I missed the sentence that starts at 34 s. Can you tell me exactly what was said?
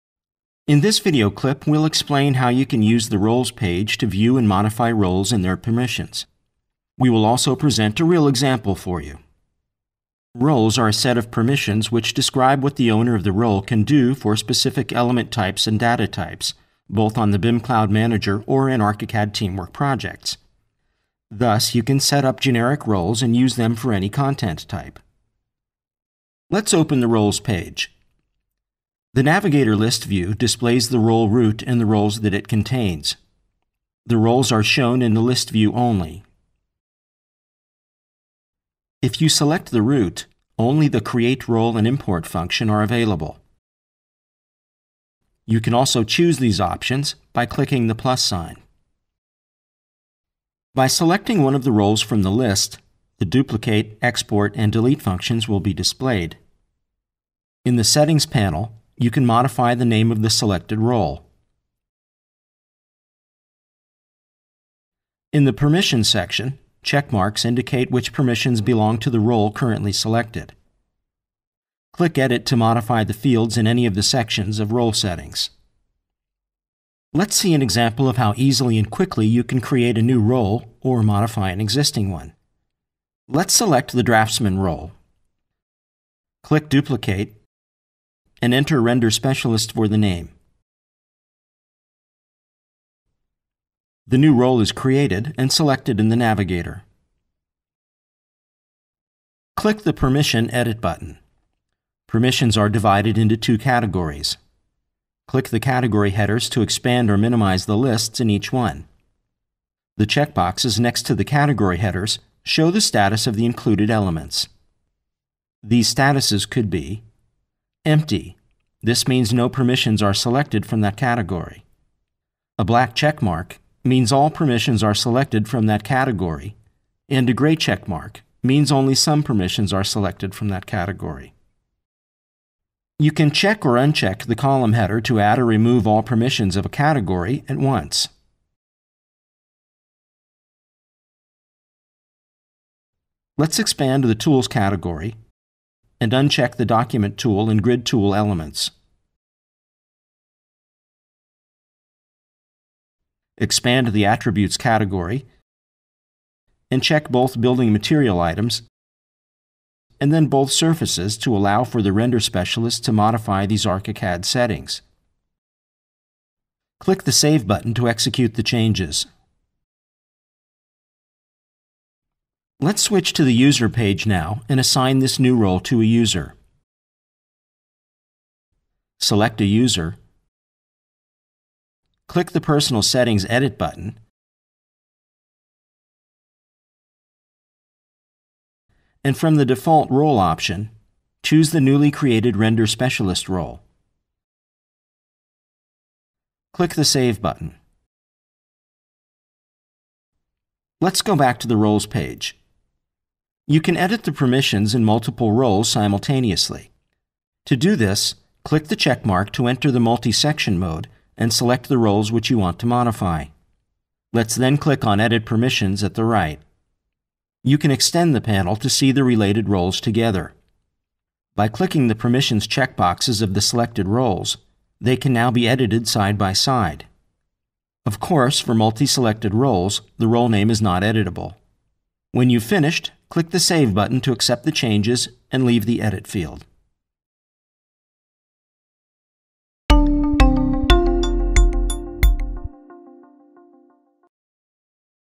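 The roles are shown in the list view only.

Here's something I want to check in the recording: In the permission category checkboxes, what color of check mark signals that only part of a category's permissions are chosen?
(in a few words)
Gray.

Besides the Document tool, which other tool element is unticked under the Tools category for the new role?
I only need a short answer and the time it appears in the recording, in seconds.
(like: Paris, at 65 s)
Grid tool, at 147 s.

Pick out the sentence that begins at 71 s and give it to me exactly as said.
Click Edit to modify the fields in any of the sections of Role Settings.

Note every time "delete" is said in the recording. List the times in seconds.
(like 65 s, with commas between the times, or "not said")
54 s.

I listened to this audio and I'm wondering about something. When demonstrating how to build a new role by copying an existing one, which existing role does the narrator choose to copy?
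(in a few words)
Draftsman.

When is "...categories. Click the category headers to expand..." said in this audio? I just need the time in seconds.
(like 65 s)
103 s.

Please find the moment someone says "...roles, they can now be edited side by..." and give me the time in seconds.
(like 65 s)
223 s.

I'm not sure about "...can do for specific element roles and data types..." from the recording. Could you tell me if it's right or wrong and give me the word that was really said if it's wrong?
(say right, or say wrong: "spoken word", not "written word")
wrong: "types", not "roles".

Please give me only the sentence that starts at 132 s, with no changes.
You can check or uncheck the column header to add or remove all permissions of a category at once.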